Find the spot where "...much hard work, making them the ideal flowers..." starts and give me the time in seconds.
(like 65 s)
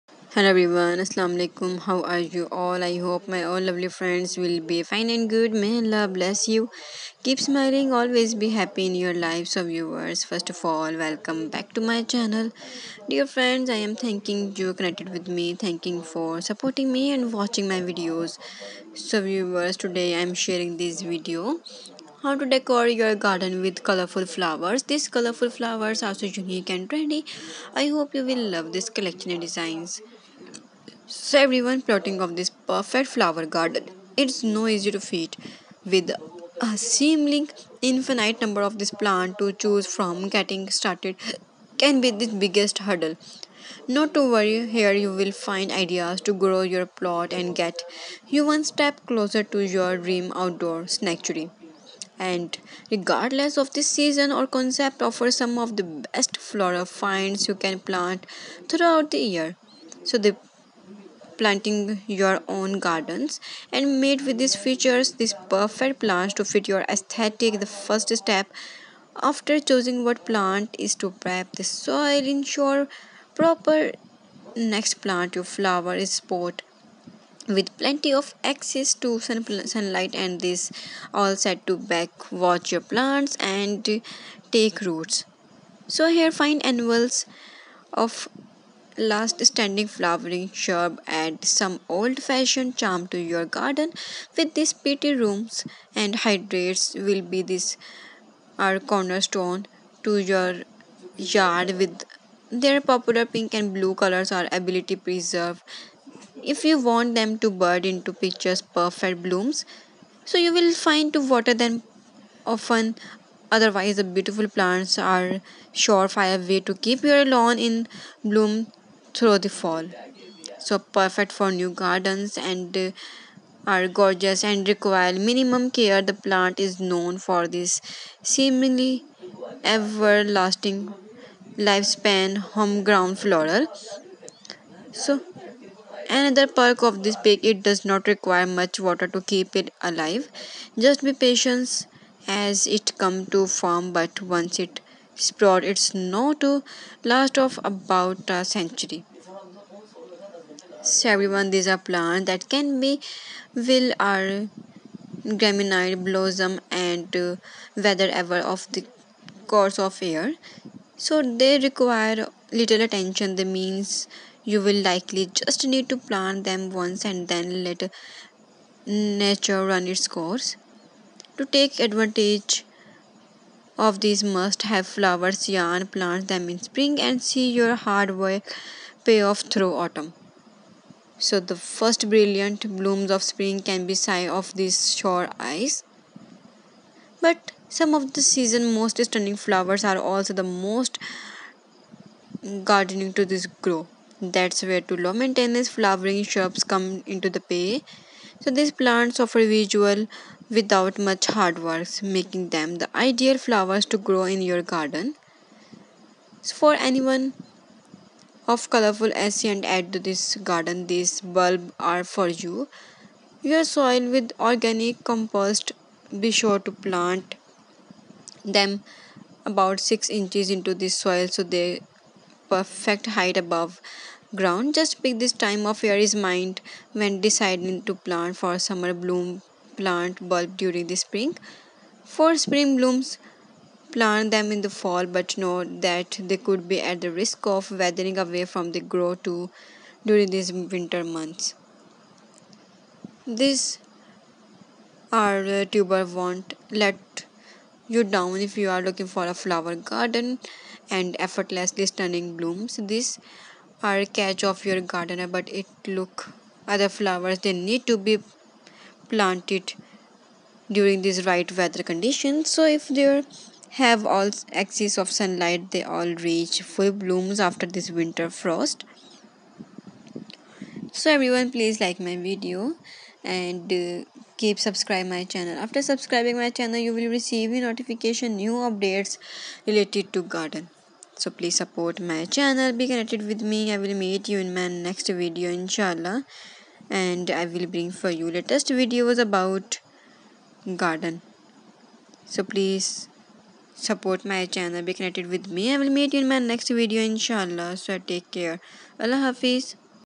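200 s.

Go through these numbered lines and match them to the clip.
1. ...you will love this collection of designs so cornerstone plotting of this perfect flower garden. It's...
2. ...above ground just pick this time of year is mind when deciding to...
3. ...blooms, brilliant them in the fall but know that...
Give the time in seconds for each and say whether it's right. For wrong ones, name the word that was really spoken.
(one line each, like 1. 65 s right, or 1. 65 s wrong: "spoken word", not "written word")
1. 28 s wrong: "everyone", not "cornerstone"
2. 223 s right
3. 232 s wrong: "plant", not "brilliant".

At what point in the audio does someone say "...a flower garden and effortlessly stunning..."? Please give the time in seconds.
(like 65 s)
249 s.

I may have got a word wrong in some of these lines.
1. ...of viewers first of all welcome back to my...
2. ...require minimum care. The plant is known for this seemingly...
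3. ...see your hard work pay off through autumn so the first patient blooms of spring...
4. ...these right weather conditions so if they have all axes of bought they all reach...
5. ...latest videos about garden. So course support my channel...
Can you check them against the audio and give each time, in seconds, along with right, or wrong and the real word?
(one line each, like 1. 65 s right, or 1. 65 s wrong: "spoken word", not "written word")
1. 9 s right
2. 124 s right
3. 177 s wrong: "brilliant", not "patient"
4. 261 s wrong: "sunlight", not "bought"
5. 288 s wrong: "please", not "course".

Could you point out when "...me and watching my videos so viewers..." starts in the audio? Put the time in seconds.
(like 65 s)
16 s.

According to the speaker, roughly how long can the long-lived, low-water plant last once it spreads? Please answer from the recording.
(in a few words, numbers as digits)
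About a century.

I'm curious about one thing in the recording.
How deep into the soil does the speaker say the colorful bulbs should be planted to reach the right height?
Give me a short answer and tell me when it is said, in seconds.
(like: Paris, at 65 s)
6 inches, at 219 s.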